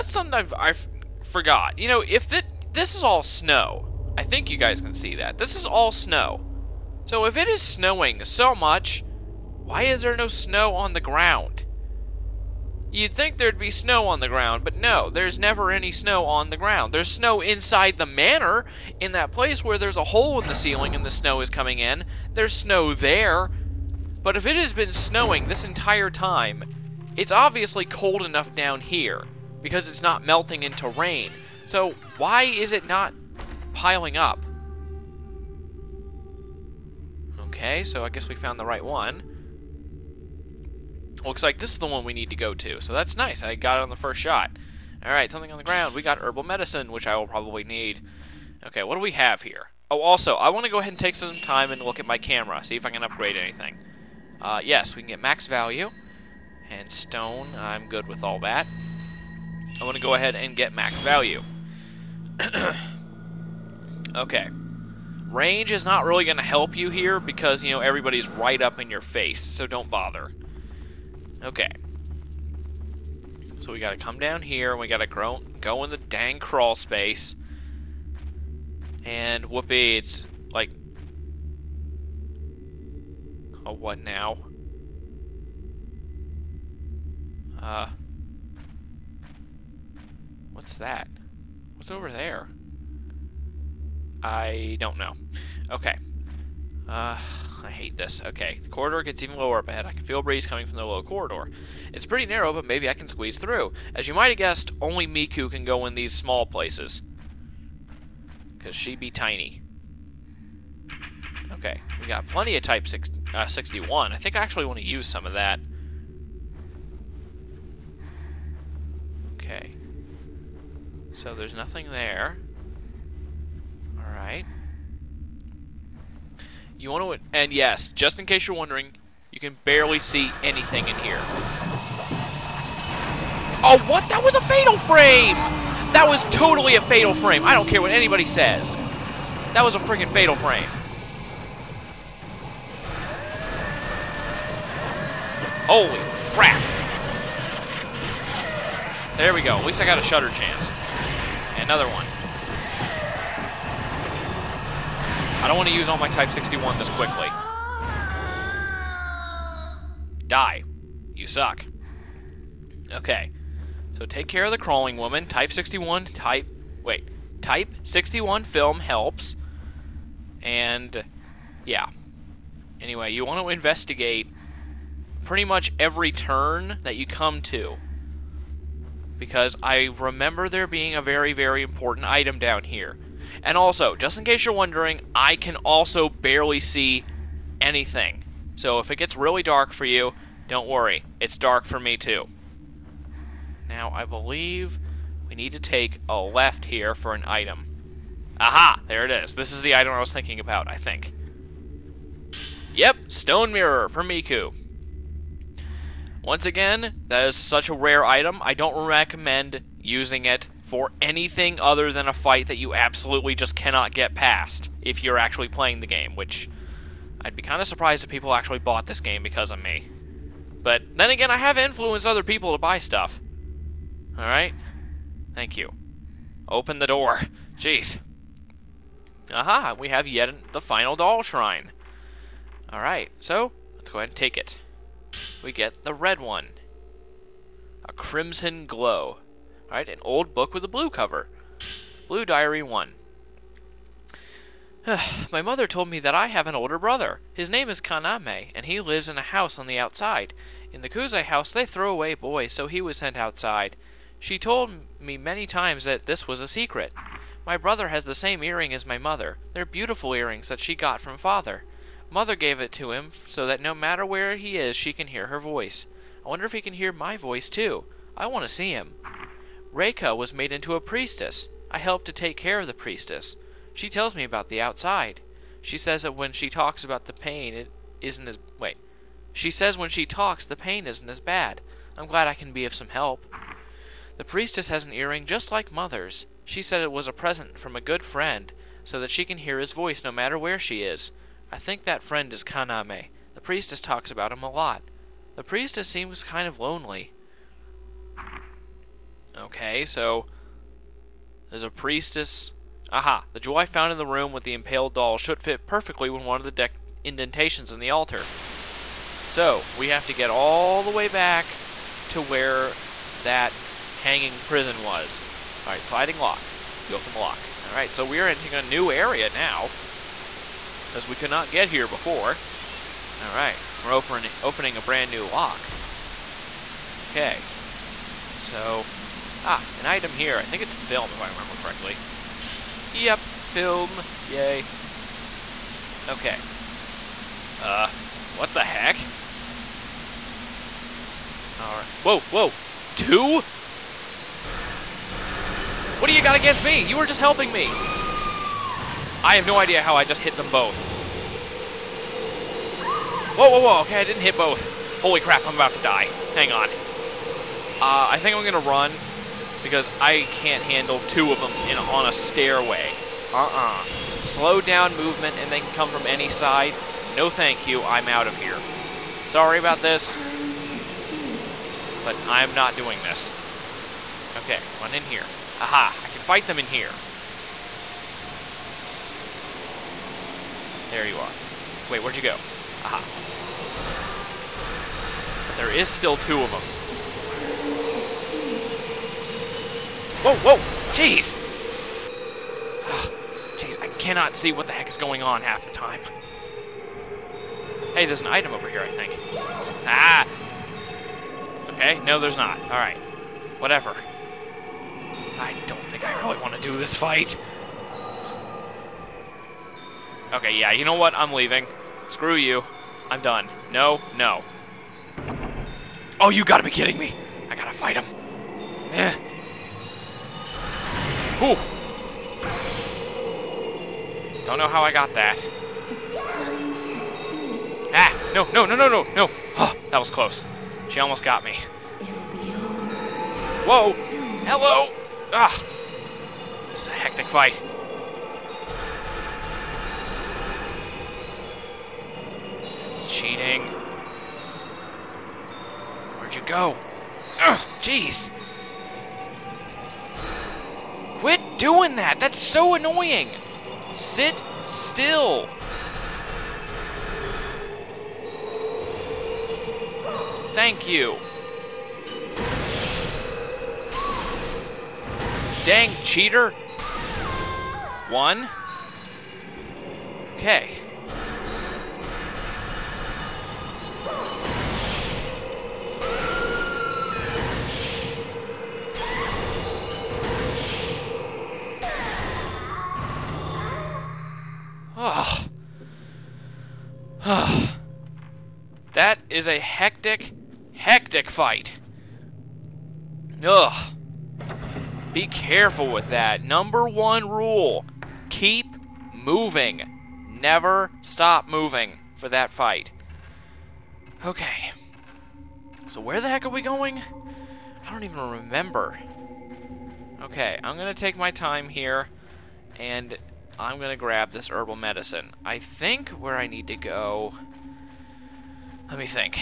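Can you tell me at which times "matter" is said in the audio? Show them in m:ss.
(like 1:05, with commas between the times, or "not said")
4:23, 4:50.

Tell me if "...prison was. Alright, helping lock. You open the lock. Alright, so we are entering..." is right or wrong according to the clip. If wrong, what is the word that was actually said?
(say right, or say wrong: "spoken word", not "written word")
wrong: "sliding", not "helping".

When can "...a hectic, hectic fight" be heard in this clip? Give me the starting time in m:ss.
8:09.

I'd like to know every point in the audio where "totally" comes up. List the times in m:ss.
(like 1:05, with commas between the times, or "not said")
2:16.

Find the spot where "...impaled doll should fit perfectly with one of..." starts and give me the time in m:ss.
5:04.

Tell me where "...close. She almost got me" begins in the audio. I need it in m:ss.
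7:10.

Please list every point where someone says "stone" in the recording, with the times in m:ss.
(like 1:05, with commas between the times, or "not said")
0:56, 3:23.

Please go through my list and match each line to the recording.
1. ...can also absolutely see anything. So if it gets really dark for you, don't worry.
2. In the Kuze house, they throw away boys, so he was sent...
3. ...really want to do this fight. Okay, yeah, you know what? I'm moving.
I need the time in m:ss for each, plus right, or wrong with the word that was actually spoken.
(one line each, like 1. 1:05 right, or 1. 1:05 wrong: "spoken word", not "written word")
1. 3:05 wrong: "barely", not "absolutely"
2. 4:10 right
3. 6:46 wrong: "leaving", not "moving".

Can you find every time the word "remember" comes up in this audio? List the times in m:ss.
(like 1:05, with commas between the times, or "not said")
2:59, 5:31, 8:28.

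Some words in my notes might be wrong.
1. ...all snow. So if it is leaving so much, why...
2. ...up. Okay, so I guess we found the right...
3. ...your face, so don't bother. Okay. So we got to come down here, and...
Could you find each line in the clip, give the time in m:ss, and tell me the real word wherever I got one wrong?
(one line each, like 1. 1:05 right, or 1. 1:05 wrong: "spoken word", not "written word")
1. 0:05 wrong: "snowing", not "leaving"
2. 0:34 right
3. 1:08 right.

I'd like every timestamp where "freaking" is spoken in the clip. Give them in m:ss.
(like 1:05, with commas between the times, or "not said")
2:19.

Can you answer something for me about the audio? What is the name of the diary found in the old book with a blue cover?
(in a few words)
Blue Diary 1.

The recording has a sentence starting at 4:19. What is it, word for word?
They're beautiful earrings that she got from father.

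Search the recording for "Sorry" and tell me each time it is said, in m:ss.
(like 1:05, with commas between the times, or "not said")
6:09.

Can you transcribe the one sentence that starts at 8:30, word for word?
Okay, I'm gonna take my time here and I'm going to grab this herbal medicine.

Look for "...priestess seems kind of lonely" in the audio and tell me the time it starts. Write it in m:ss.
4:55.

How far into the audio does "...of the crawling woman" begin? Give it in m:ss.
2:44.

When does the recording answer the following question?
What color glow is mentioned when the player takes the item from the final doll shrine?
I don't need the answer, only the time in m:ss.
3:57.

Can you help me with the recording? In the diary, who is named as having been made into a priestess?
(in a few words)
Reika.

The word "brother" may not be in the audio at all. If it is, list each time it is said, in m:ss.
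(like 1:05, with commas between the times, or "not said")
4:06, 4:17.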